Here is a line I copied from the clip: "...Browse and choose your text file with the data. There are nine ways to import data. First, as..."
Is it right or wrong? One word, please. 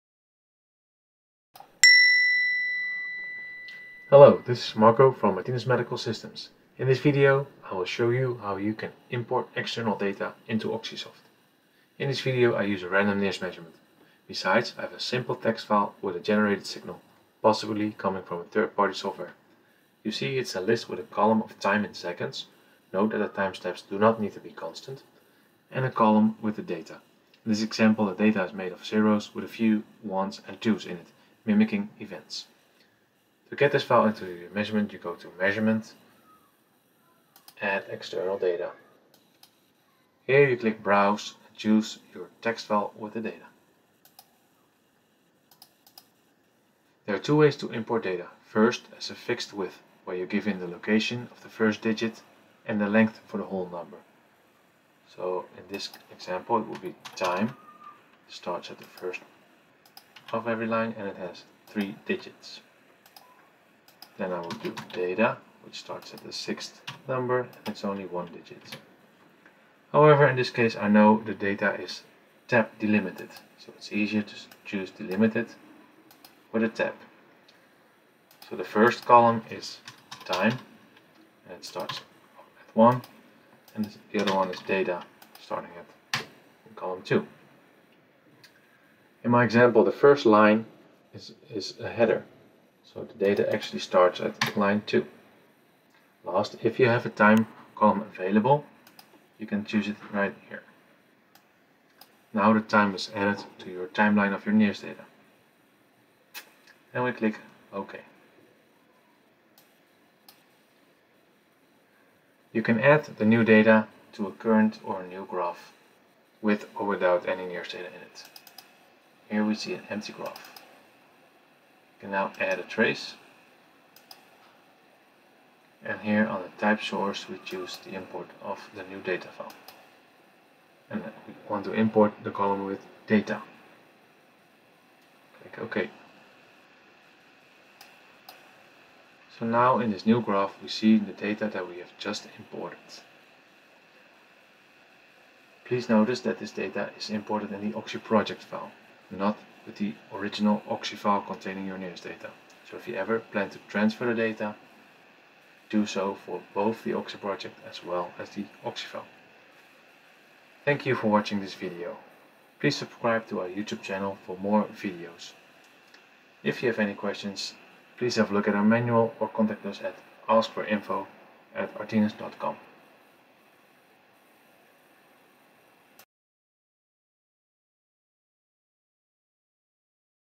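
wrong.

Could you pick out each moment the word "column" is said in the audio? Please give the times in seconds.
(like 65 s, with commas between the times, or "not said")
21 s, 25 s, 79 s, 86 s, 97 s, 132 s.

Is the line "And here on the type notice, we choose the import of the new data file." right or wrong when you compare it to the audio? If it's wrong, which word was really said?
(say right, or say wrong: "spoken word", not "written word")
wrong: "source", not "notice".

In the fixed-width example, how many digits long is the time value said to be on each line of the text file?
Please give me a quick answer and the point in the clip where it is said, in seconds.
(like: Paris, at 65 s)
3, at 61 s.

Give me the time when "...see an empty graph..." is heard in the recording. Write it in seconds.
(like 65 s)
119 s.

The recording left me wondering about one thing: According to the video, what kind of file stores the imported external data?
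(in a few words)
Oxy project file.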